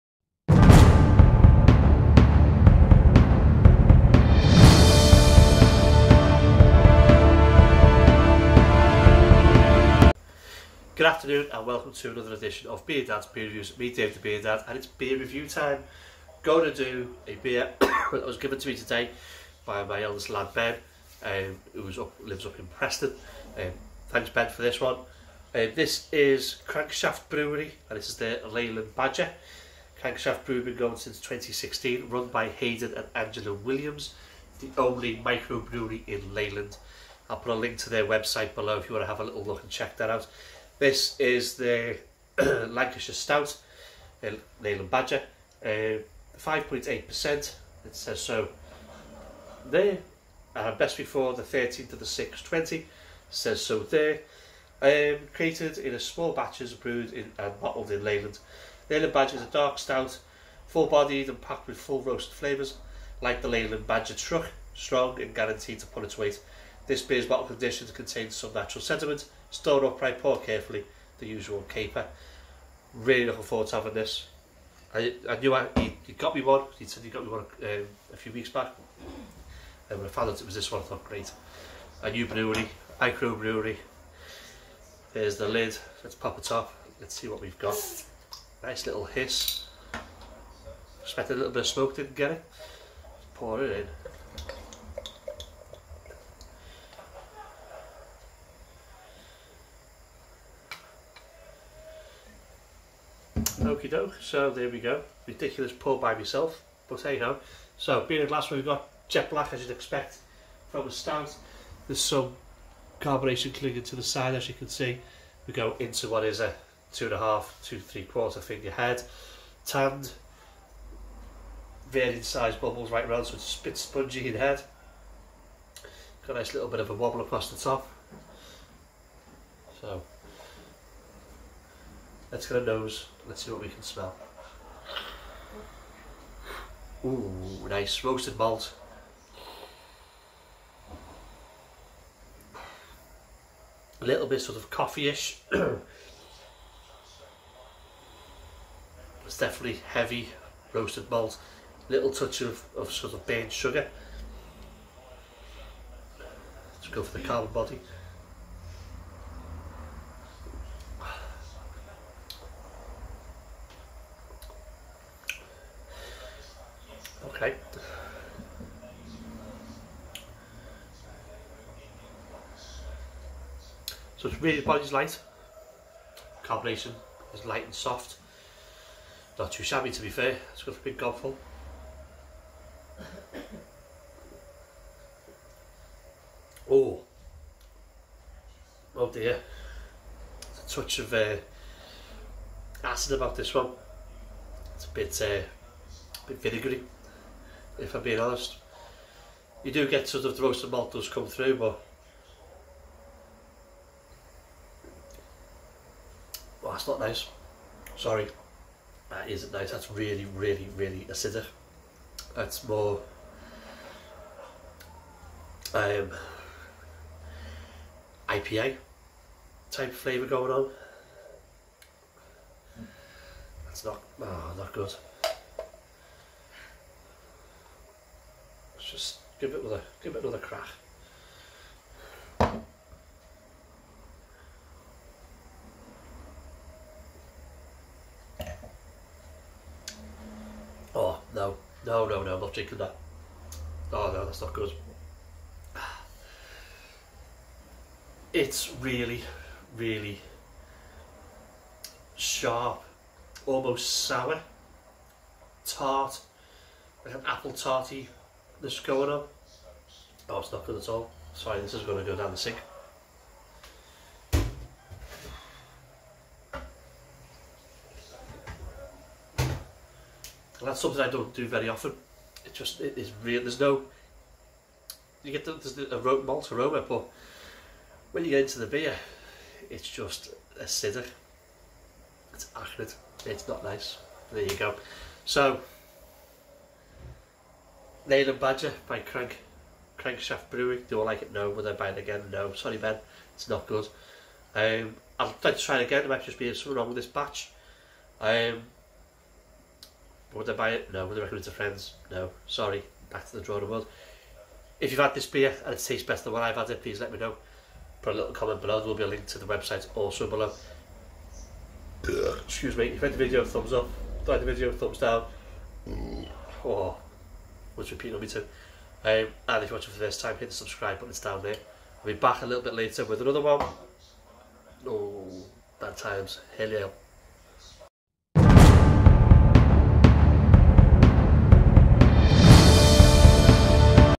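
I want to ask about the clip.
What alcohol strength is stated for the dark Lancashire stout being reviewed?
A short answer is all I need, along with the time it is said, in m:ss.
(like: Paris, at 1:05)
5.8%, at 0:45.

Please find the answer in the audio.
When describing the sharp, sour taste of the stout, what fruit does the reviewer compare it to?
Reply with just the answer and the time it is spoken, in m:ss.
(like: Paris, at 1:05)
Apple, at 4:17.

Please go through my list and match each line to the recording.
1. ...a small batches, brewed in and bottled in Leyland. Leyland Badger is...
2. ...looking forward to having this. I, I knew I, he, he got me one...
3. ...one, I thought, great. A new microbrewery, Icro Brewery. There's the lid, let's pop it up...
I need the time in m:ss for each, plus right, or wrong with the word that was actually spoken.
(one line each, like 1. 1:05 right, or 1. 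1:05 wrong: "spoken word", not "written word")
1. 0:55 right
2. 1:13 right
3. 1:20 wrong: "brewery", not "microbrewery".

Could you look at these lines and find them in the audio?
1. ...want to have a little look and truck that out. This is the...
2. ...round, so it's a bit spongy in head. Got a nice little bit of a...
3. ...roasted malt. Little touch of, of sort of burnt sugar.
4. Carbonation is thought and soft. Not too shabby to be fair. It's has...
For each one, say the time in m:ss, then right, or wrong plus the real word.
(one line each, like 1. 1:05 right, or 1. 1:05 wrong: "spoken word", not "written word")
1. 0:38 wrong: "check", not "truck"
2. 2:03 right
3. 2:30 right
4. 2:56 wrong: "light", not "thought".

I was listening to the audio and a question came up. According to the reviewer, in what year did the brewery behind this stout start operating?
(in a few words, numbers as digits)
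2016.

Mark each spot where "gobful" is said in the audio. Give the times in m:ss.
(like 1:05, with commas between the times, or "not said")
3:00.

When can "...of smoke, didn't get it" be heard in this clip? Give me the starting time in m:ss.
1:31.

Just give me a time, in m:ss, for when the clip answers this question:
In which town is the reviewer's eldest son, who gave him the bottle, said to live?
0:22.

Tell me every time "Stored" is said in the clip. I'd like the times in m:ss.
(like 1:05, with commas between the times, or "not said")
1:09.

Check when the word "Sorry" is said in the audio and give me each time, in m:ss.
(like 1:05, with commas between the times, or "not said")
3:27, 4:21, 4:52, 5:02.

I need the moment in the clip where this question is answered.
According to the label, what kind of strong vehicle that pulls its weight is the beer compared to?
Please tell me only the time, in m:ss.
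1:04.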